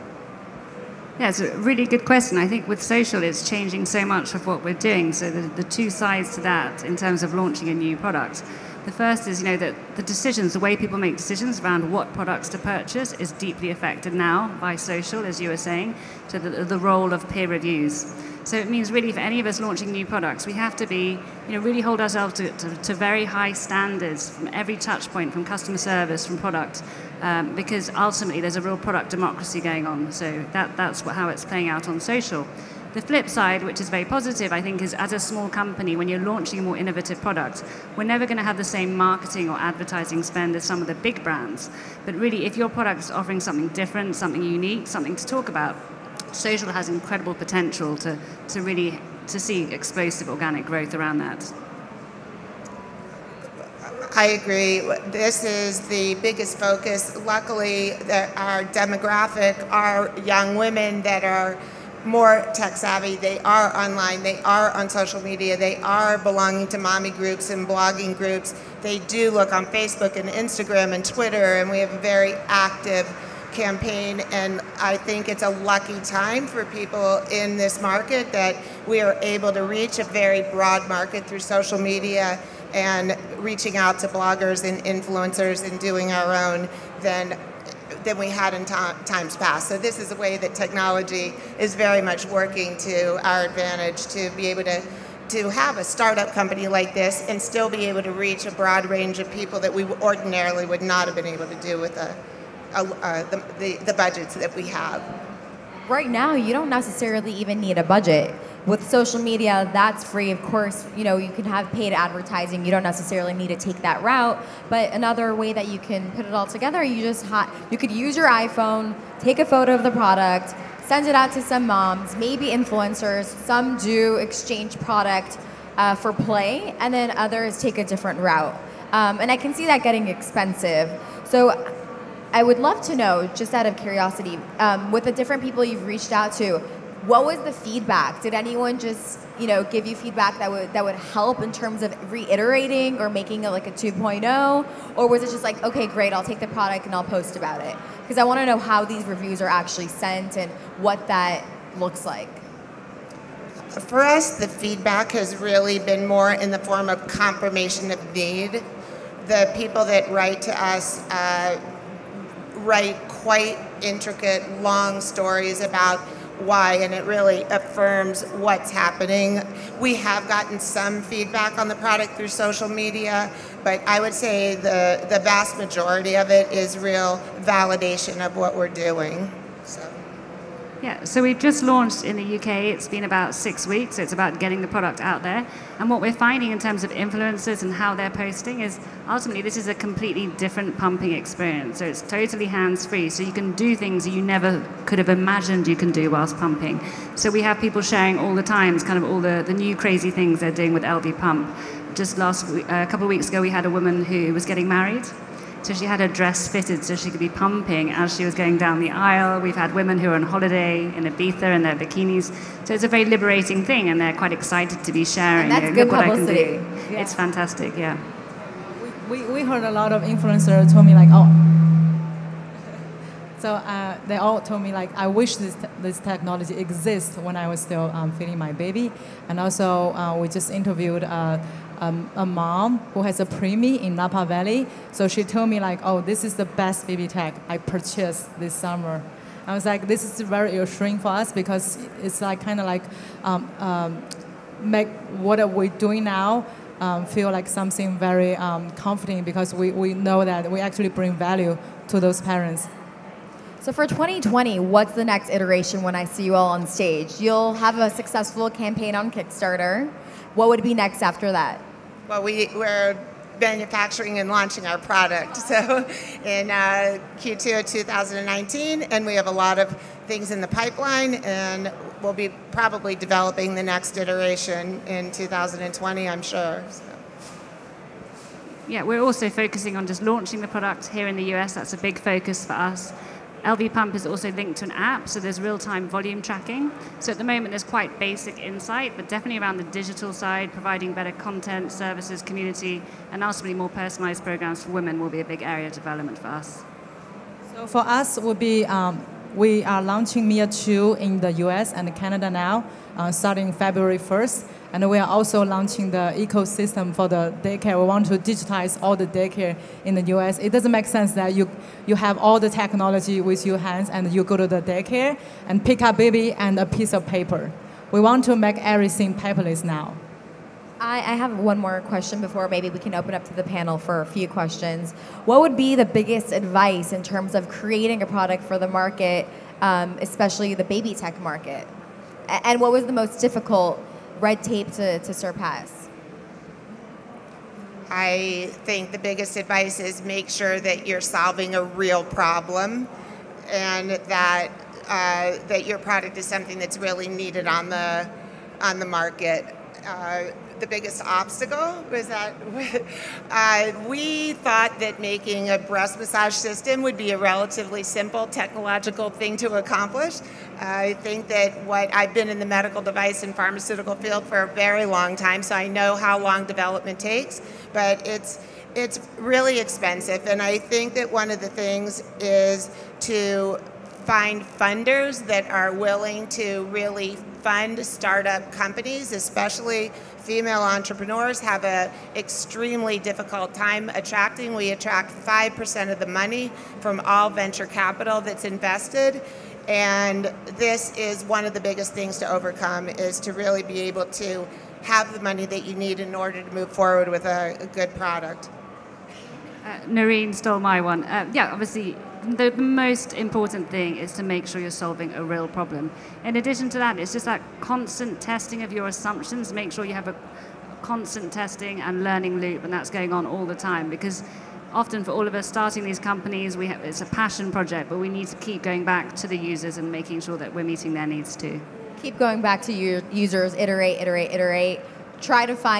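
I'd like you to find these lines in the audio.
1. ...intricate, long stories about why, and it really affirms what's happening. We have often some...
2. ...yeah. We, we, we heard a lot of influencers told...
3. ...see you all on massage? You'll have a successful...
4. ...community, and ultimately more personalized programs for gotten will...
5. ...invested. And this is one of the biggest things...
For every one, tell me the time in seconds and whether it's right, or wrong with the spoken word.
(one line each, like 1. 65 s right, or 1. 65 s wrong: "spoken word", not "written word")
1. 163 s wrong: "gotten", not "often"
2. 217 s right
3. 256 s wrong: "stage", not "massage"
4. 292 s wrong: "women", not "gotten"
5. 388 s right.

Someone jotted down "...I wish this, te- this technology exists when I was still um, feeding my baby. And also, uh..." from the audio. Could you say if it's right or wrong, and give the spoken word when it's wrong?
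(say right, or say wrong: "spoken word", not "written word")
right.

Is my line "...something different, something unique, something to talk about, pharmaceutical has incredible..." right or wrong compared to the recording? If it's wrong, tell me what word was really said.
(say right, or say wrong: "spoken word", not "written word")
wrong: "social", not "pharmaceutical".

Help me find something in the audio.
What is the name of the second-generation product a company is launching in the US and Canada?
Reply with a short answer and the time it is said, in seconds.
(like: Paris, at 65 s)
Mia 2, at 300 s.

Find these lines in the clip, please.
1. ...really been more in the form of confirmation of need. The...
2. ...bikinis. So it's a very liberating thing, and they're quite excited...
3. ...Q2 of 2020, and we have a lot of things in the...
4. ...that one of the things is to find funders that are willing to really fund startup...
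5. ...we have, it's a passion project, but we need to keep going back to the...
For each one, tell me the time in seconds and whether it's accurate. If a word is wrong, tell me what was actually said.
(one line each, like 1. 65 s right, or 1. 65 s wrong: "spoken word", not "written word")
1. 155 s right
2. 211 s right
3. 267 s wrong: "2019", not "2020"
4. 370 s right
5. 416 s right.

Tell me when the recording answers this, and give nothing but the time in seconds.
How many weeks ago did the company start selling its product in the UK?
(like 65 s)
183 s.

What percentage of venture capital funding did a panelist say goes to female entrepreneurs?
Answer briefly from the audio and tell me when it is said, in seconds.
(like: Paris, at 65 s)
5%, at 385 s.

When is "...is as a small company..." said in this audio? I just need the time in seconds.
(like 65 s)
34 s.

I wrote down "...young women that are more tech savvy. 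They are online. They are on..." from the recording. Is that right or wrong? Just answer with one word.
right.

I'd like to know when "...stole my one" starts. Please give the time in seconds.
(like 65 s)
400 s.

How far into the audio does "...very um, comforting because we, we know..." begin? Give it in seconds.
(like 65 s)
247 s.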